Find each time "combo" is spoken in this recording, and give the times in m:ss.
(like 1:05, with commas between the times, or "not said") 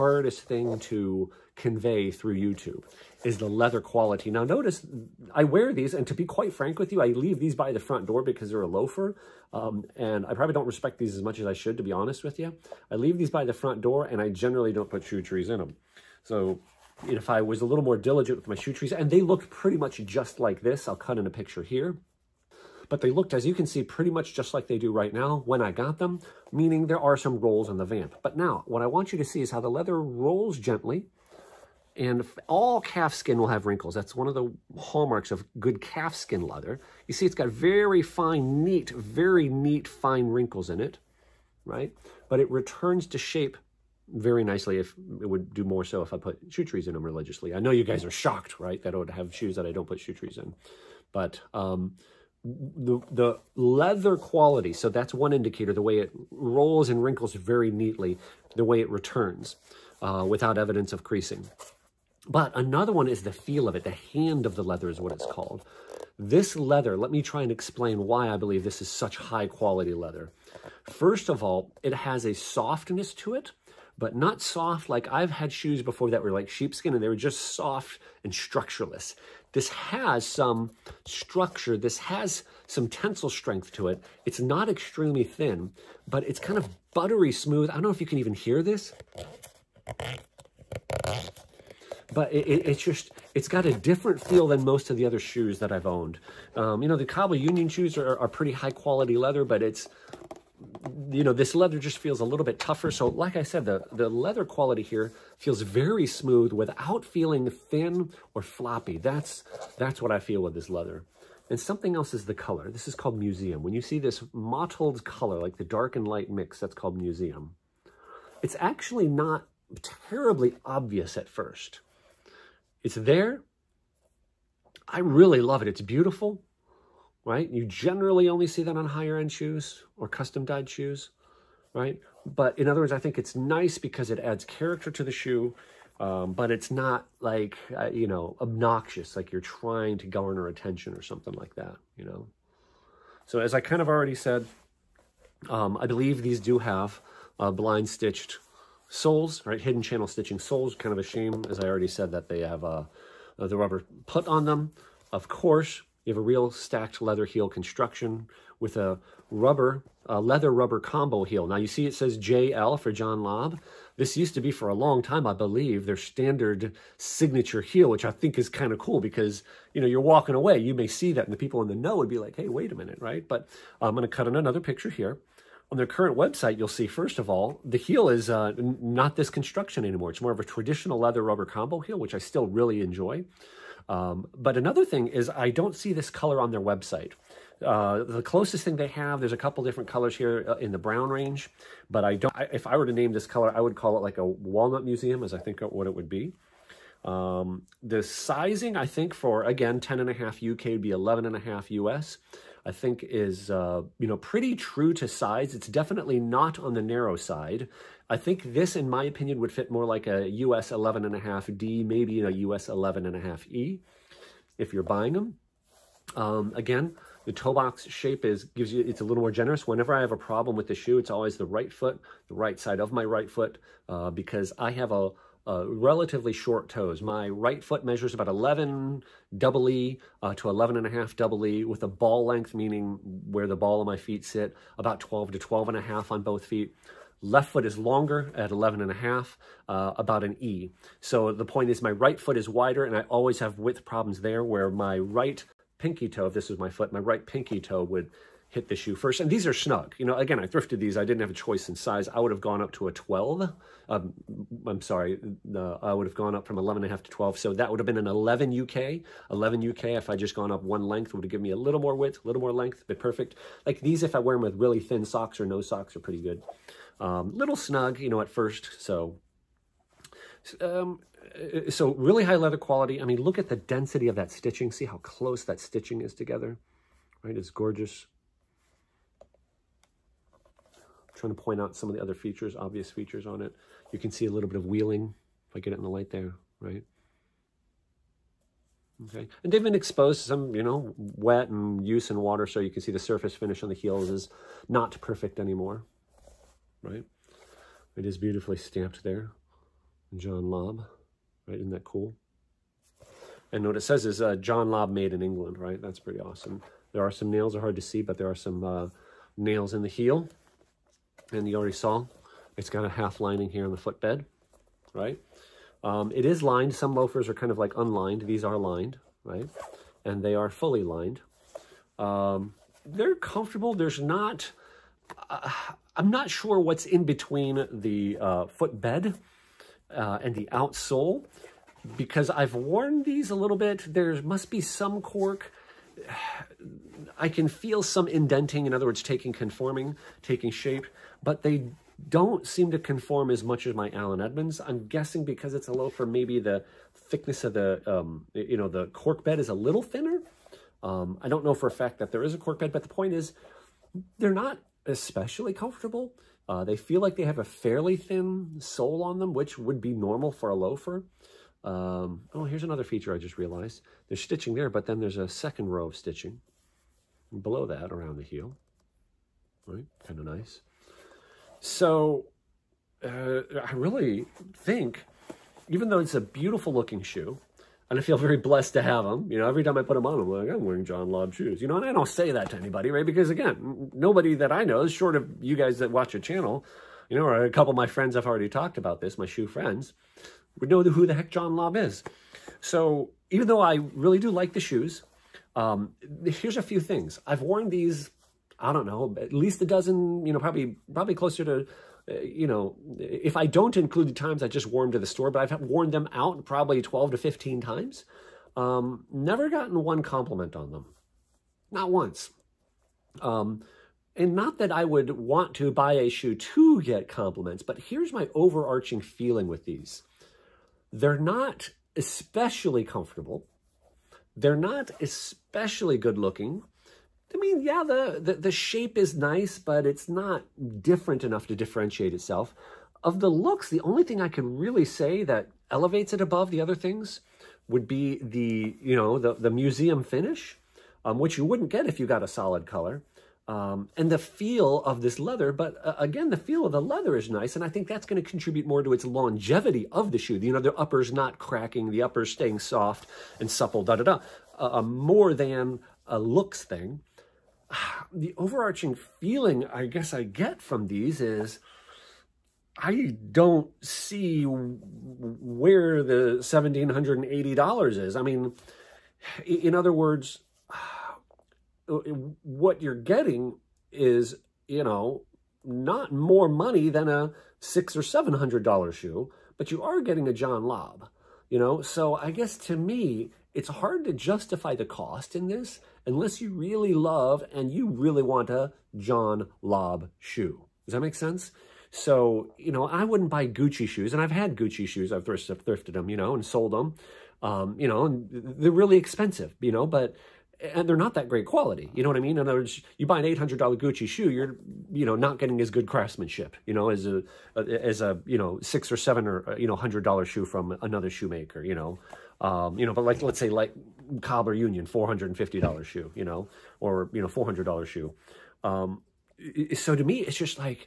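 2:40, 3:01.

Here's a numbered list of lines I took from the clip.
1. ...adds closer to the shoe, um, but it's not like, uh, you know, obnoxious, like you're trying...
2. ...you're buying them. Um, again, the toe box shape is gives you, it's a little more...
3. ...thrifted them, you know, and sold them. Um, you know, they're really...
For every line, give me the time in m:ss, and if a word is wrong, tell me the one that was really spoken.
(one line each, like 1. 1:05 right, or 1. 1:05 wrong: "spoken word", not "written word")
1. 2:14 wrong: "character", not "closer"
2. 3:34 right
3. 8:15 right.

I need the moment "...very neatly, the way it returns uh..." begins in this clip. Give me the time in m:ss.
0:57.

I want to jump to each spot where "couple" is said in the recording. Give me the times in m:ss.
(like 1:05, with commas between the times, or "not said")
3:09, 6:27.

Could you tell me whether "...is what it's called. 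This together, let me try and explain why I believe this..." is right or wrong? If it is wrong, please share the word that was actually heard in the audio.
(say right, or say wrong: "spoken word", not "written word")
wrong: "leather", not "together".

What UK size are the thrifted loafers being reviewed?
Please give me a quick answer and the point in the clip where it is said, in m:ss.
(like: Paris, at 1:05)
10.5 UK, at 3:19.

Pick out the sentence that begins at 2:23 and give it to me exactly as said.
So as I kind of already said, um, I believe these do have uh, blind stitched soles, right?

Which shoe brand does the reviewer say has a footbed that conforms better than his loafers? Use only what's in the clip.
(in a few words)
Allen Edmonds.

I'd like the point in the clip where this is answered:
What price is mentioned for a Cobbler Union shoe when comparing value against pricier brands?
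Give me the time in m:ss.
8:34.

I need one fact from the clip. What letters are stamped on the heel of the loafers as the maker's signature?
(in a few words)
JL.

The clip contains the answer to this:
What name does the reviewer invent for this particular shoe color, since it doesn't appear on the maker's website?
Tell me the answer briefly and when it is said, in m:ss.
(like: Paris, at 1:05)
Walnut museum, at 3:14.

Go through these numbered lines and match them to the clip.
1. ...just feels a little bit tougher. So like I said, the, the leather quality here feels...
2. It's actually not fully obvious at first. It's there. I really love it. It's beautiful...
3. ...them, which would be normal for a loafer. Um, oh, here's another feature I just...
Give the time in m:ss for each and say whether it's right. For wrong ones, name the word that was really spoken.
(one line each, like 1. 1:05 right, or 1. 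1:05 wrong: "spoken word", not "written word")
1. 1:41 right
2. 1:58 wrong: "terribly", not "fully"
3. 5:59 right.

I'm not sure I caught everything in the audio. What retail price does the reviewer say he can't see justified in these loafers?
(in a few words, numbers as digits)
$1,780.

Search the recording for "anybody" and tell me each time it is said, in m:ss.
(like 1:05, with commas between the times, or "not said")
6:22.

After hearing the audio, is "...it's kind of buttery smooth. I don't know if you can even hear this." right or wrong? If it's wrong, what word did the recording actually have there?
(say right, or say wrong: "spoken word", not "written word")
right.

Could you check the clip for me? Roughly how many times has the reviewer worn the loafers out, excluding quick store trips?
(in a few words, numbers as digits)
12 to 15.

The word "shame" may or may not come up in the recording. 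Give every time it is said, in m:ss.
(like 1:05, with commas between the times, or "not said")
2:31.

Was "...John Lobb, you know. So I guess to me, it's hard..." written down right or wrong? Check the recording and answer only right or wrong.
right.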